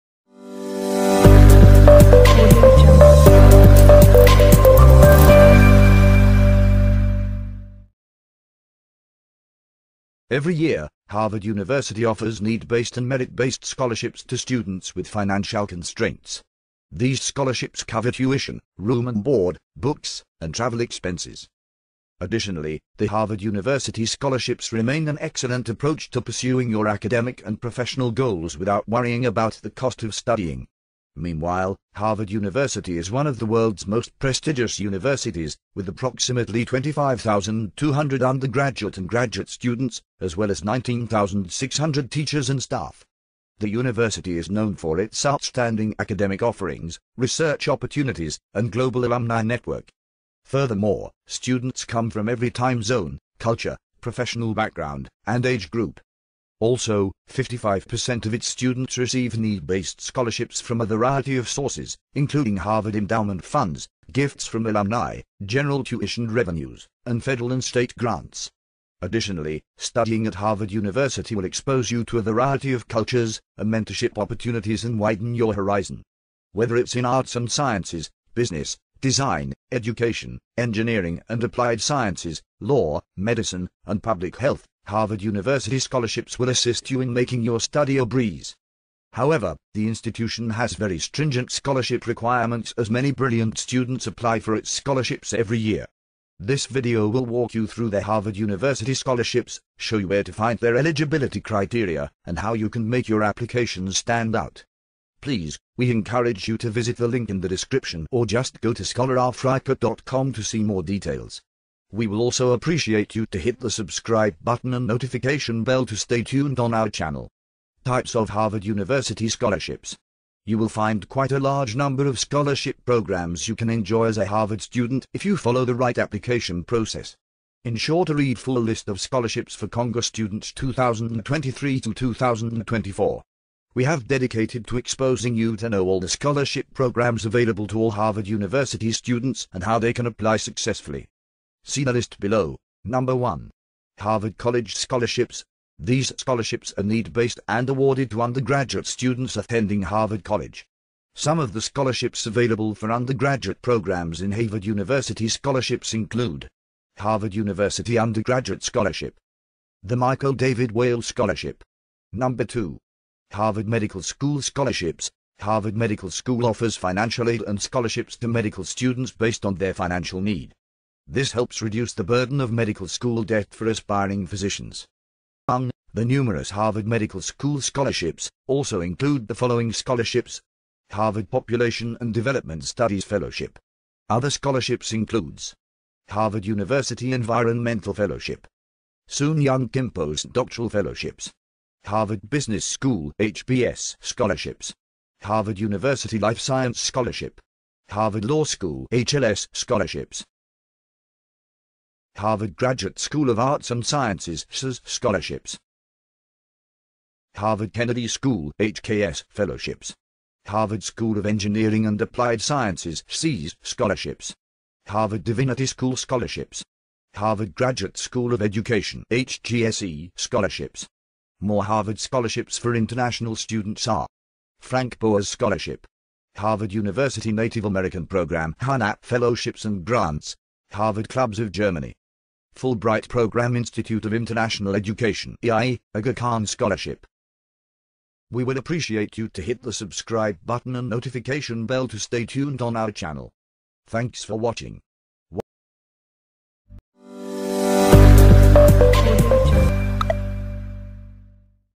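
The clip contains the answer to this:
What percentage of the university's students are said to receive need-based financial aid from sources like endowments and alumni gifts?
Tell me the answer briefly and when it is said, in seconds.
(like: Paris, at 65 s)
55%, at 57 s.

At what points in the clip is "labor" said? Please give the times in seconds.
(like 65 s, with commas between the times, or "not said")
not said.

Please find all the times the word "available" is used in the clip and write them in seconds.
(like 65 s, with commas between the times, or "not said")
137 s, 152 s.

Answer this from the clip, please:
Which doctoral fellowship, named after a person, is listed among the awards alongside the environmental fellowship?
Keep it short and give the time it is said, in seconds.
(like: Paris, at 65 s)
Soon Young Kim Doctoral Fellowships, at 189 s.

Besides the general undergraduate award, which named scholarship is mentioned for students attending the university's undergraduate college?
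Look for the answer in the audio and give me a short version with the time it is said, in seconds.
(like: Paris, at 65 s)
Michael David Whale Scholarship, at 159 s.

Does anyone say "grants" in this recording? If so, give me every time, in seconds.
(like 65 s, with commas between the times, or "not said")
67 s, 229 s.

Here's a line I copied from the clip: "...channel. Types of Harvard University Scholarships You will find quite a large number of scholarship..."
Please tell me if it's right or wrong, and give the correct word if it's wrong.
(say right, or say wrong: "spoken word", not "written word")
right.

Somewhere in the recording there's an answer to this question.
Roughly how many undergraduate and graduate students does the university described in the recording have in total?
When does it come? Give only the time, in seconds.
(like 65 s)
36 s.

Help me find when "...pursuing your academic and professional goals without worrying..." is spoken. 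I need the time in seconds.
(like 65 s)
26 s.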